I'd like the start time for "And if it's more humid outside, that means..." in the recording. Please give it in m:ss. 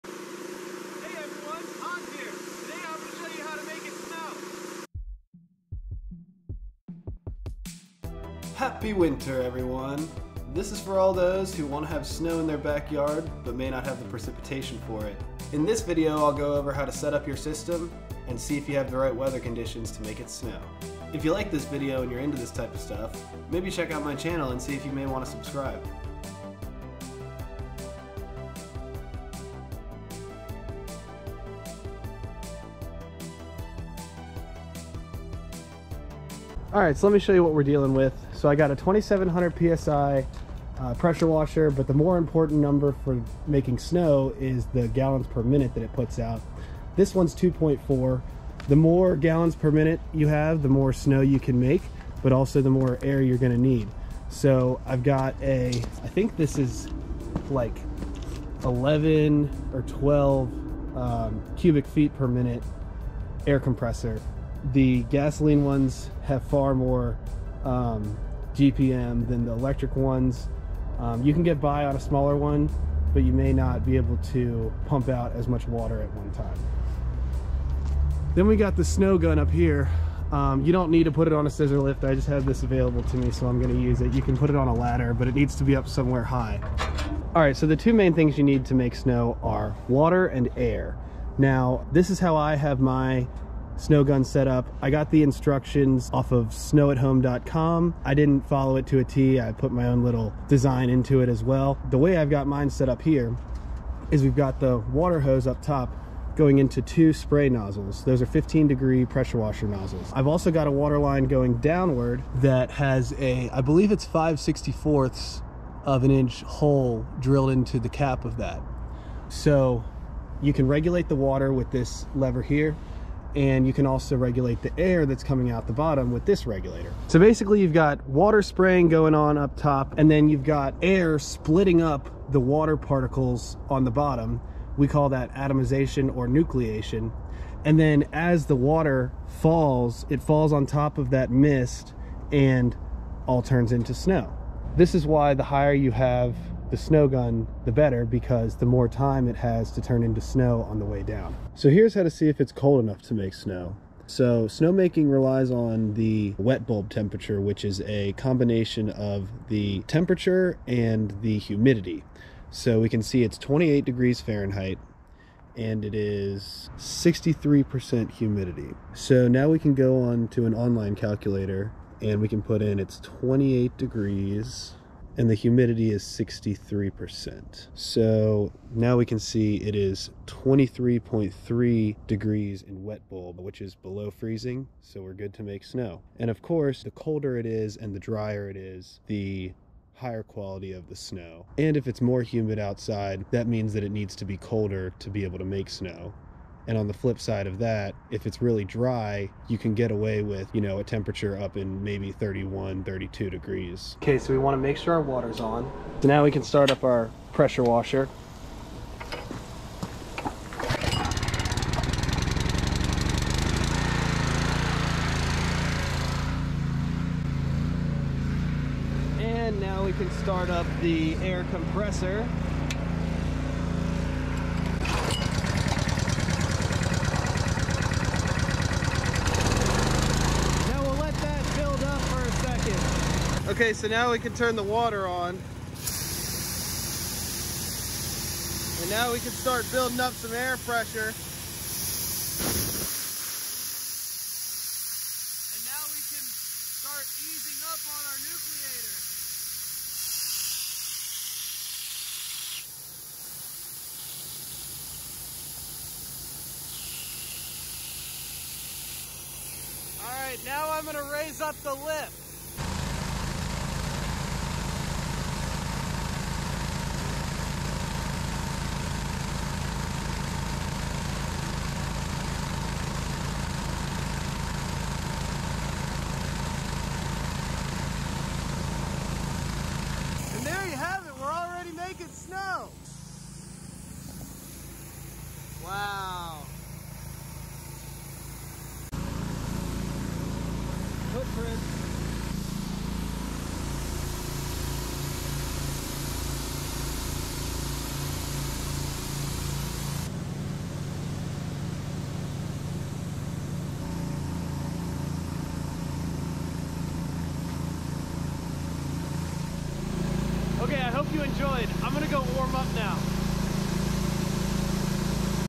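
3:11.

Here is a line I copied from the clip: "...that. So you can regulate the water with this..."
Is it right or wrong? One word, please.
right.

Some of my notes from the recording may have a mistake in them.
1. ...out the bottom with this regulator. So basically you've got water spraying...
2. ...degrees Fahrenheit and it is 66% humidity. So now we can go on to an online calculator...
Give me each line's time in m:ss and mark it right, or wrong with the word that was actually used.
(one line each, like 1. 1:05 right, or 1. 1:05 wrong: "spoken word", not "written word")
1. 2:05 right
2. 2:43 wrong: "63", not "66".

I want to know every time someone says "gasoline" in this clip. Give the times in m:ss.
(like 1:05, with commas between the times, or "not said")
1:05.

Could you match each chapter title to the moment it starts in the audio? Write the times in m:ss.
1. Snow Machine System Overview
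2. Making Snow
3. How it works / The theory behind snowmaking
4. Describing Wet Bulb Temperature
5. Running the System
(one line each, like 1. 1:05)
1. 0:36
2. 4:29
3. 1:26
4. 2:30
5. 3:24.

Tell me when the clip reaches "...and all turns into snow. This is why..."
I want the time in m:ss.
2:22.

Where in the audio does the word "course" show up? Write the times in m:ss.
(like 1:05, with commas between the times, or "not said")
3:06.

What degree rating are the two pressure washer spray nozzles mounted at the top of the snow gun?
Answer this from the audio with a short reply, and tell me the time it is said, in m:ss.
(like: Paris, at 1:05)
15 degree, at 1:48.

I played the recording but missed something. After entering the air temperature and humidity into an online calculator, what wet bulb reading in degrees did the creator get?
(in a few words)
23.3.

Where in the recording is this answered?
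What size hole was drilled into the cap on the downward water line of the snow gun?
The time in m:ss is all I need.
1:54.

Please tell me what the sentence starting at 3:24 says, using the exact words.
Okay, so we want to make sure our water's on.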